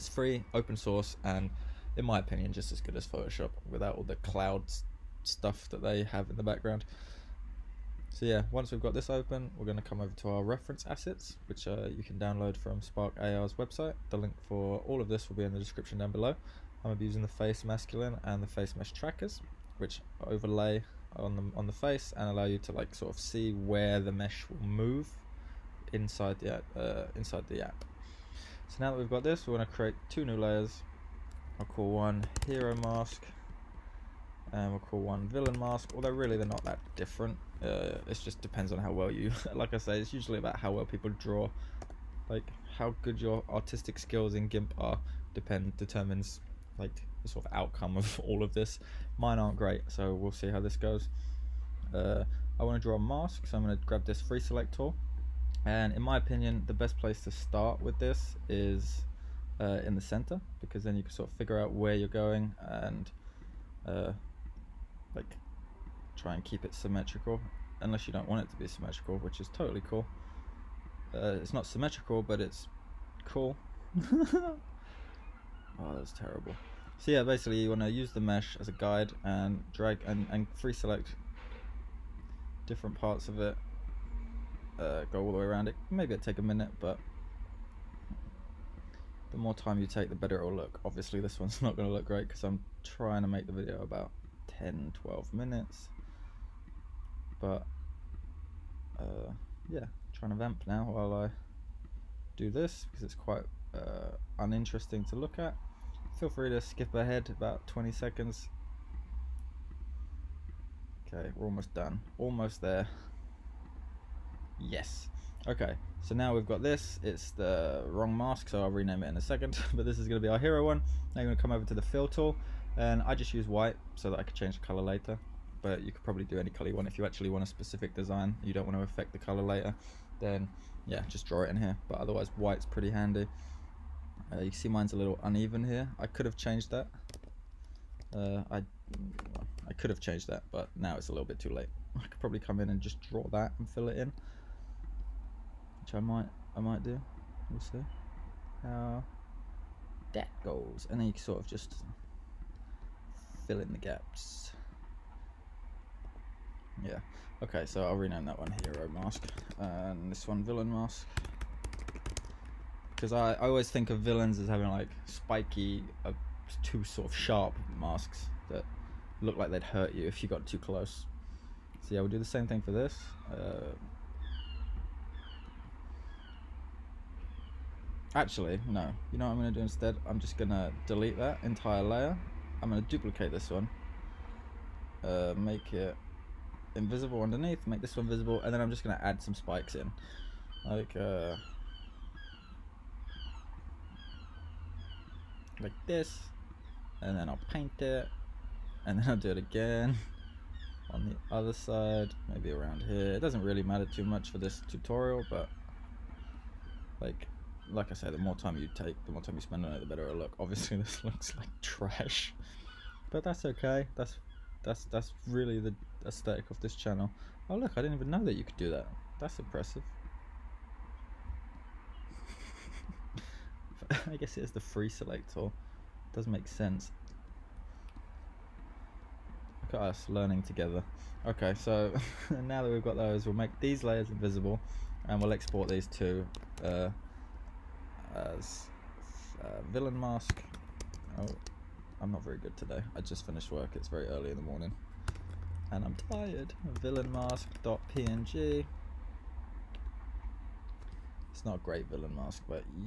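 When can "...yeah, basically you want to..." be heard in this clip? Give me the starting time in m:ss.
1:17.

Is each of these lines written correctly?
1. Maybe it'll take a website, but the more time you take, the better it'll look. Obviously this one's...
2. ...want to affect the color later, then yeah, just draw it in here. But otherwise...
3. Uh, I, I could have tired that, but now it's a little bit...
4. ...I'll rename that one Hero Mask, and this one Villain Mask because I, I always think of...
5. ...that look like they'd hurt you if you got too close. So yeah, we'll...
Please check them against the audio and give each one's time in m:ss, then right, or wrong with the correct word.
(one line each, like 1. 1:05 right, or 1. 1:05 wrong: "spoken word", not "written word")
1. 1:25 wrong: "minute", not "website"
2. 2:08 right
3. 2:18 wrong: "changed", not "tired"
4. 2:37 right
5. 2:48 right.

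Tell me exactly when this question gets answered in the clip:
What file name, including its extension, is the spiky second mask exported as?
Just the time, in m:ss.
4:06.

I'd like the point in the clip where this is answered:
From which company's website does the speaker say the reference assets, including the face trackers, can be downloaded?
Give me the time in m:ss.
0:12.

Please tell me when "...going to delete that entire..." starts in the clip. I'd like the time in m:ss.
3:00.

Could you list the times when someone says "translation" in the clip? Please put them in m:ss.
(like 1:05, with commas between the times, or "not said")
not said.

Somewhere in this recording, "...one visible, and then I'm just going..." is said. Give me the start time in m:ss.
3:07.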